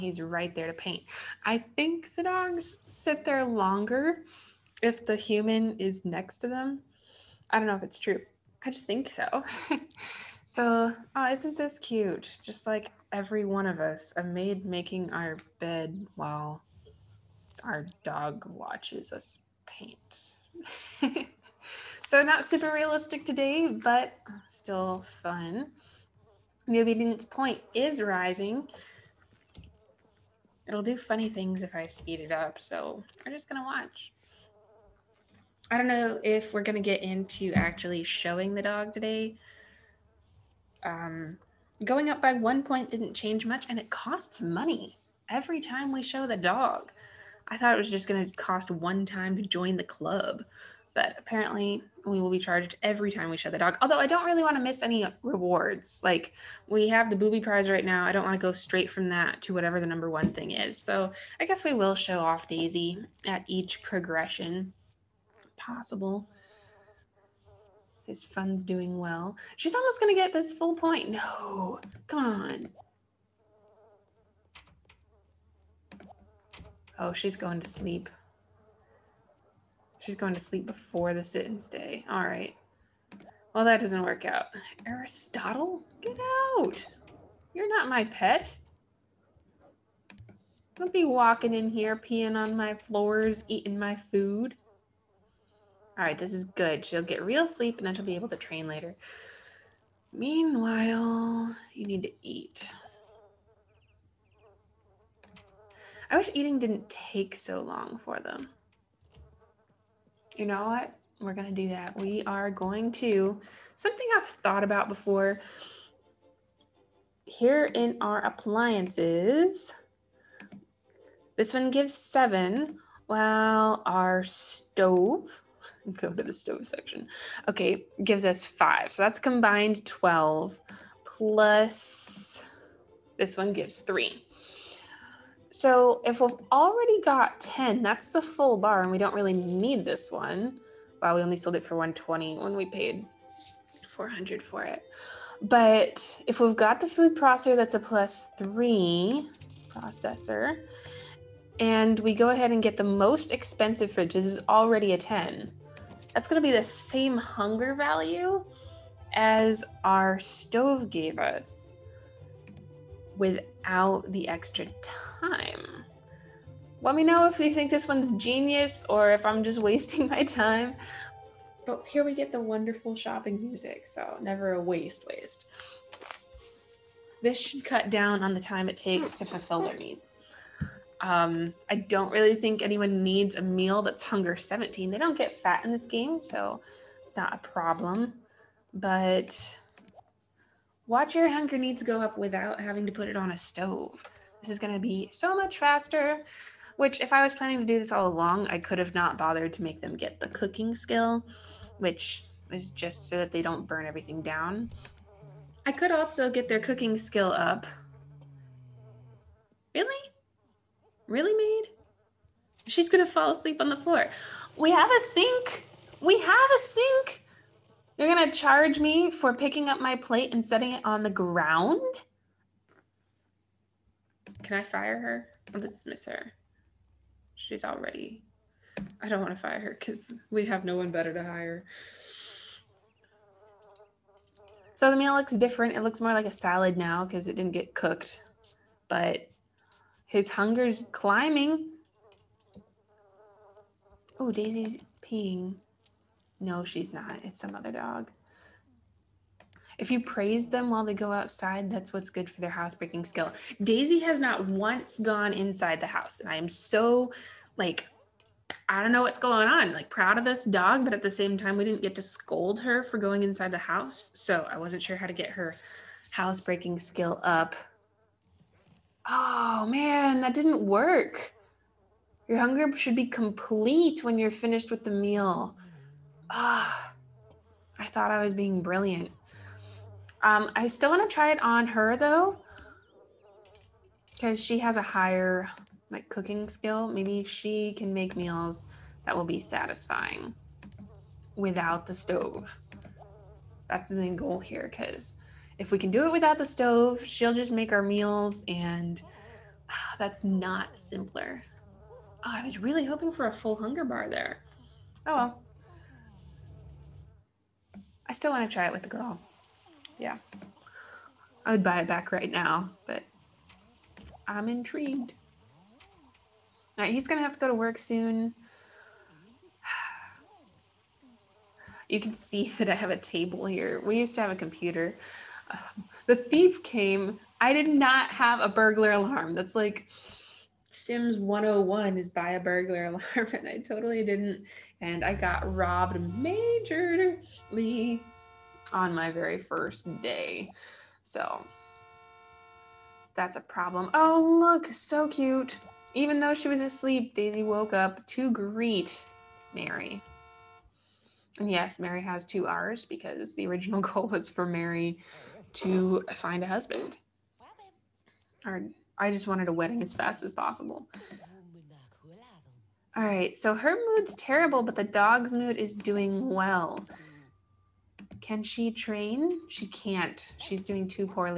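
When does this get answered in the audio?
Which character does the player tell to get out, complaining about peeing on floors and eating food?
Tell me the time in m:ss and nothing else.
1:24.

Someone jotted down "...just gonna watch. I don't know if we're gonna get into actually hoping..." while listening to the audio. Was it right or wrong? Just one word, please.
wrong.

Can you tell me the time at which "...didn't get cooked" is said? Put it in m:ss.
3:57.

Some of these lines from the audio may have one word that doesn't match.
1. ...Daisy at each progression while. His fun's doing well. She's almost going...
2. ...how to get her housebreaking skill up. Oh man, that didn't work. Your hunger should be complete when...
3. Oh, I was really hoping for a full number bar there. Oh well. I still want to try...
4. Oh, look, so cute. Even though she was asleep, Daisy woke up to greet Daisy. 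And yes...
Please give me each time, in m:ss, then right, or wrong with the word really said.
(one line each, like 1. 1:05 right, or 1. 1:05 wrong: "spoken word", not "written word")
1. 1:02 wrong: "possible", not "while"
2. 4:24 right
3. 5:02 wrong: "hunger", not "number"
4. 5:43 wrong: "Marry", not "Daisy".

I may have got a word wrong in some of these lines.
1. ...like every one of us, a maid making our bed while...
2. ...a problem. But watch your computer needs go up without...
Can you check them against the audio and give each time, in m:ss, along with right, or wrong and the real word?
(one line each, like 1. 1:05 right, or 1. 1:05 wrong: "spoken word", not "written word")
1. 0:12 right
2. 3:07 wrong: "hunger", not "computer".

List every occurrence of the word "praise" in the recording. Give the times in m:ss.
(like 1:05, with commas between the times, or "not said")
4:09.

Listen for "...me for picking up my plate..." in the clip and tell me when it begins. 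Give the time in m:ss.
3:38.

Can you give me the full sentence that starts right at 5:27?
I did not have a burglar alarm.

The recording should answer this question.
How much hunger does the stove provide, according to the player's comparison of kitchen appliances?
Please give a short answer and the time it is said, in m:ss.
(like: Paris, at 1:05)
5, at 2:08.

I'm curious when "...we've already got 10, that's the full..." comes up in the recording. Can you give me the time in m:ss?
2:16.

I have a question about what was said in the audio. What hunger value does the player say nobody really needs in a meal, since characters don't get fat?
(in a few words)
17.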